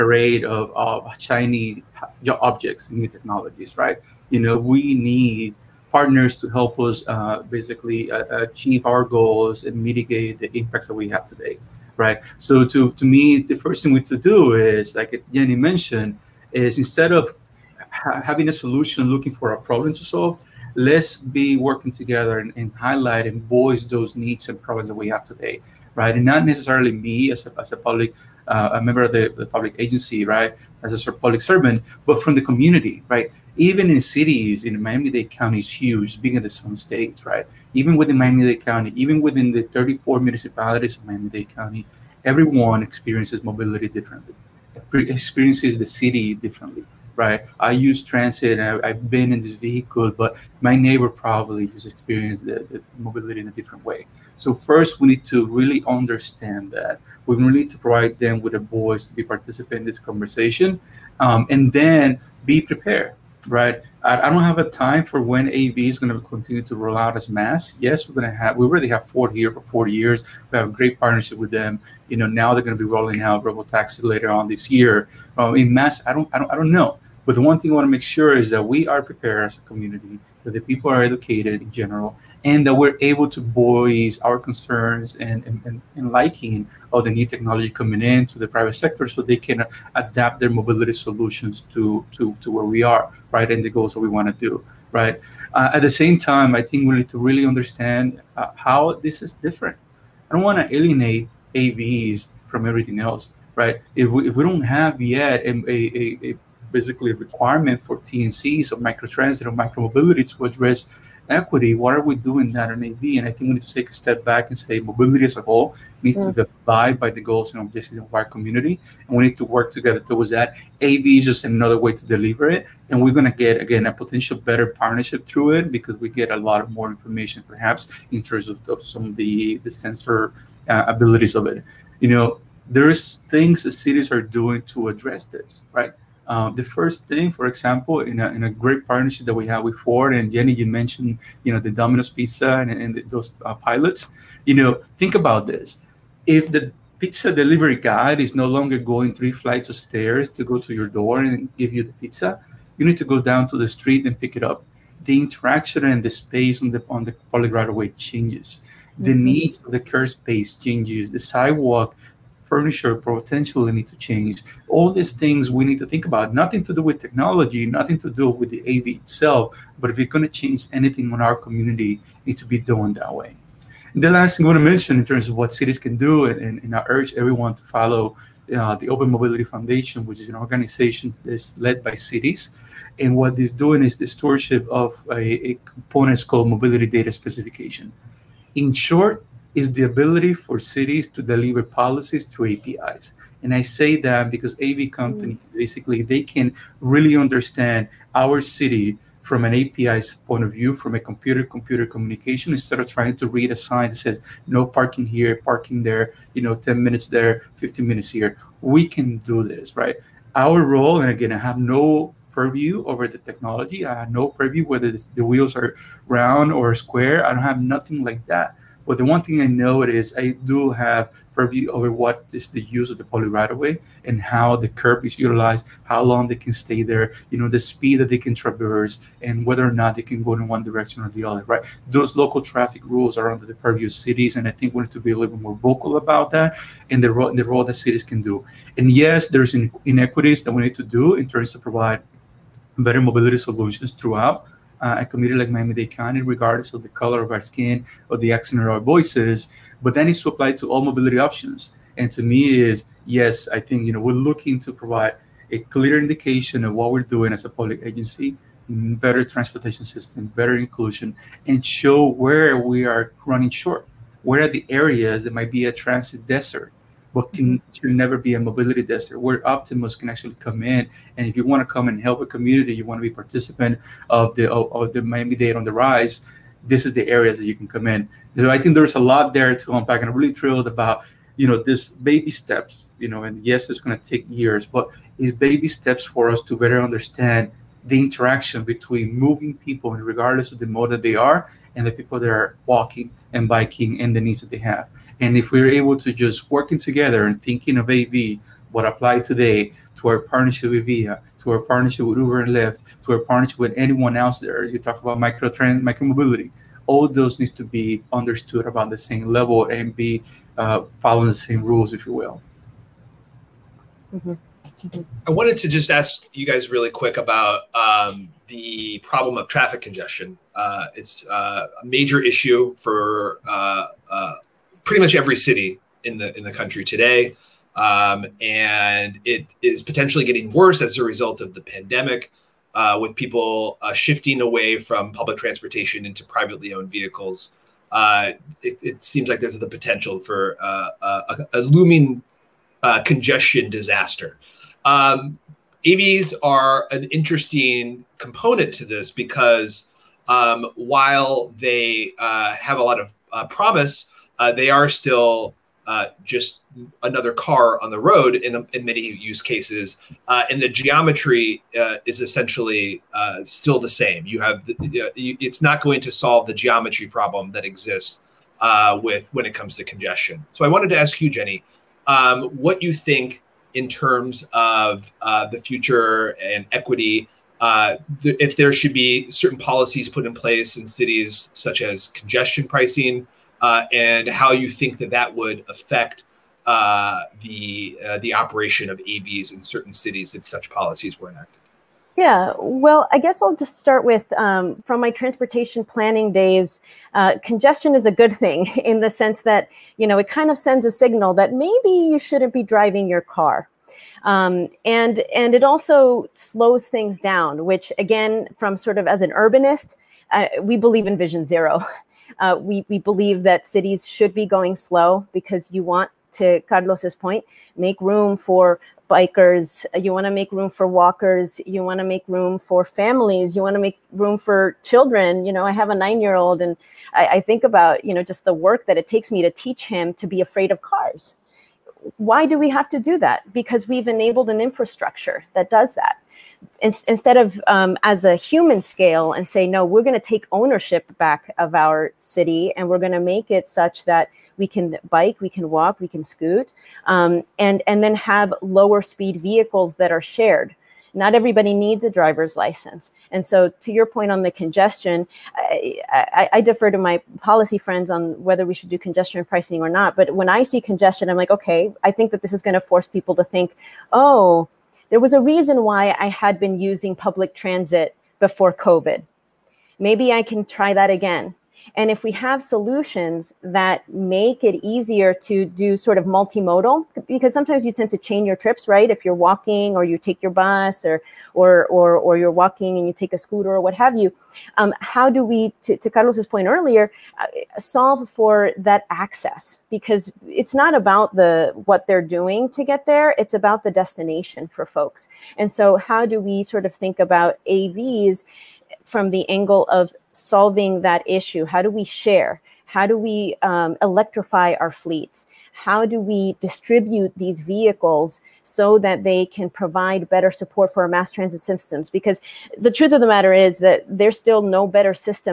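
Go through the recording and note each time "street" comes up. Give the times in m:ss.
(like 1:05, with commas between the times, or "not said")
2:33.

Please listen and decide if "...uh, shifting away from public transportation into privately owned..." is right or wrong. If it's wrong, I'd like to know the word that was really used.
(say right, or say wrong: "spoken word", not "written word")
right.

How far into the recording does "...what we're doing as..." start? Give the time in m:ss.
4:16.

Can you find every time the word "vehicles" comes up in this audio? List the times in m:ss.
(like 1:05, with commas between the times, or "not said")
0:49, 5:36, 7:29, 8:27.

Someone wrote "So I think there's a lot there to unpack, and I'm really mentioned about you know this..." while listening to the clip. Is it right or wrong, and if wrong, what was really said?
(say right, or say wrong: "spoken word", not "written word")
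wrong: "thrilled", not "mentioned".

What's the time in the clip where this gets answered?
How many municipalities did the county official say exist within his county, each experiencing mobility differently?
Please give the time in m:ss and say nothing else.
0:39.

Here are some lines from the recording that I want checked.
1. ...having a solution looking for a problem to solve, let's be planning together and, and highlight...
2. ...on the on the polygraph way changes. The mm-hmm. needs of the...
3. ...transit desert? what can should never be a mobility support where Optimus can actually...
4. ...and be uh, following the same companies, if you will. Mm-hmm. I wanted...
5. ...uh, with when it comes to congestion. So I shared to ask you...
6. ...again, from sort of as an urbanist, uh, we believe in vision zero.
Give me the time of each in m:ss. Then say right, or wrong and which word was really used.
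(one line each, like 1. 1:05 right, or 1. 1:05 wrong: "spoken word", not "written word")
1. 0:18 wrong: "working", not "planning"
2. 2:36 right
3. 4:25 wrong: "desert", not "support"
4. 5:09 wrong: "rules", not "companies"
5. 6:08 wrong: "wanted", not "shared"
6. 6:47 right.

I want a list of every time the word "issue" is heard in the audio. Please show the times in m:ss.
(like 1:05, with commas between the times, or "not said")
5:22, 8:21.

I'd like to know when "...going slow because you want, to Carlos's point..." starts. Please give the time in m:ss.
6:54.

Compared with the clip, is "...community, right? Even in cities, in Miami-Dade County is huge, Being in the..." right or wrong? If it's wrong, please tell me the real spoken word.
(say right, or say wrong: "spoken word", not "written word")
right.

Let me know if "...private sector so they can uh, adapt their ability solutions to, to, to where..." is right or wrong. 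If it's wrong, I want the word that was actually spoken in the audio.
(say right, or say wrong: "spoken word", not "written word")
wrong: "mobility", not "ability".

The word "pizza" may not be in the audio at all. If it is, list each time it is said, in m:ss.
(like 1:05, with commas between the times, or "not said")
2:22, 2:26, 2:31.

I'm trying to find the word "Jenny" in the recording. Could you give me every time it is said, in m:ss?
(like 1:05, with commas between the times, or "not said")
0:15, 2:20, 6:11.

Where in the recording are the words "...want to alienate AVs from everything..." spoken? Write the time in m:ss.
1:40.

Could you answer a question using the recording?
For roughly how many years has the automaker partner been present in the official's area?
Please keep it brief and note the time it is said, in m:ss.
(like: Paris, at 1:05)
40 years, at 1:09.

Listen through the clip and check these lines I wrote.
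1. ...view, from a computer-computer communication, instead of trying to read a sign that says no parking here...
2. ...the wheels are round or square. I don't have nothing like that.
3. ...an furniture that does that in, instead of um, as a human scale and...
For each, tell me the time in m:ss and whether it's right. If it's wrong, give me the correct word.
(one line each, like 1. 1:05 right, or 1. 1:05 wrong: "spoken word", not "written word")
1. 3:20 right
2. 3:34 right
3. 7:14 wrong: "infrastructure", not "furniture".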